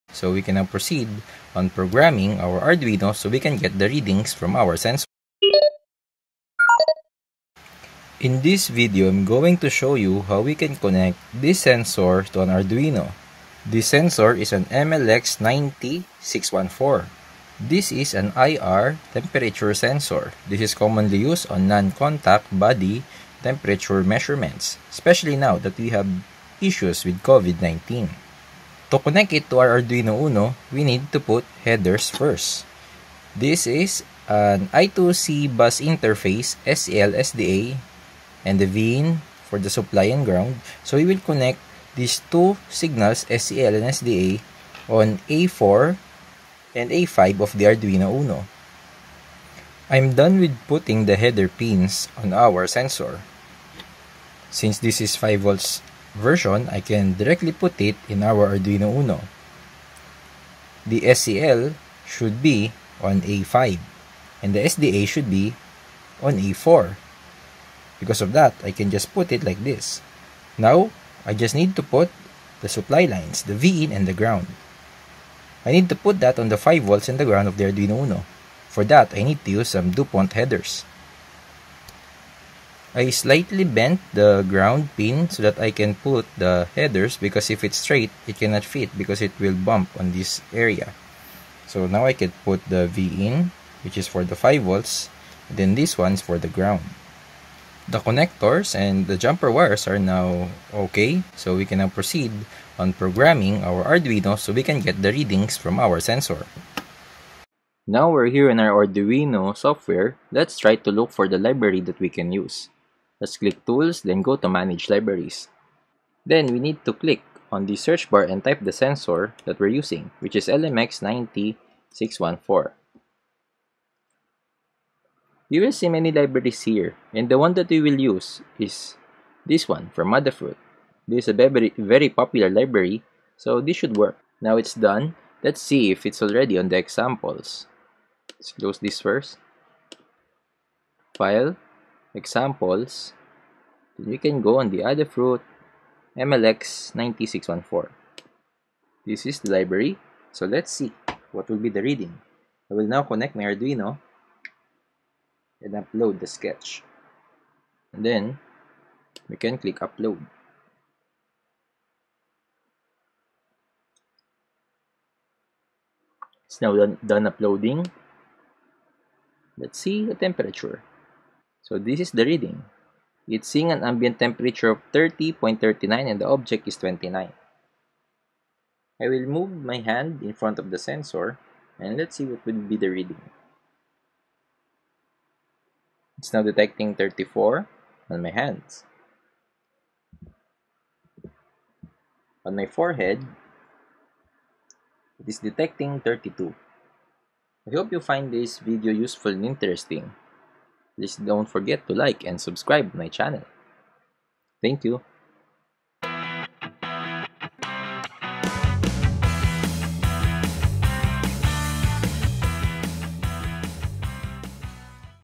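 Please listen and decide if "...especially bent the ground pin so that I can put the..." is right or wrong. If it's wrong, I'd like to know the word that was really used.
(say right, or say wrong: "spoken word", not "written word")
wrong: "slightly", not "especially".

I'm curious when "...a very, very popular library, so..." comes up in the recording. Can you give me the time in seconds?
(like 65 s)
131 s.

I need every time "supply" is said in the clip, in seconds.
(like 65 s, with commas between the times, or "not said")
39 s, 72 s.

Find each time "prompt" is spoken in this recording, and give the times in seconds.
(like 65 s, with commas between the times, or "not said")
not said.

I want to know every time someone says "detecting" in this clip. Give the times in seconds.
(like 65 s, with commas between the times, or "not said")
186 s, 195 s.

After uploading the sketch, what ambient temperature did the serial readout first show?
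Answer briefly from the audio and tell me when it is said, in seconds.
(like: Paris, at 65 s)
30.39, at 174 s.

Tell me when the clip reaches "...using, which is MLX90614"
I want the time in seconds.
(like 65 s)
119 s.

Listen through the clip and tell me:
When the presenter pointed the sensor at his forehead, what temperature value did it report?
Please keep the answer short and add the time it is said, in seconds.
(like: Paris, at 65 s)
32, at 195 s.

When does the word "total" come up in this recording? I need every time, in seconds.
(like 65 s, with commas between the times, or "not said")
not said.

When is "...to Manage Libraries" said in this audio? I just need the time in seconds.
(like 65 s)
114 s.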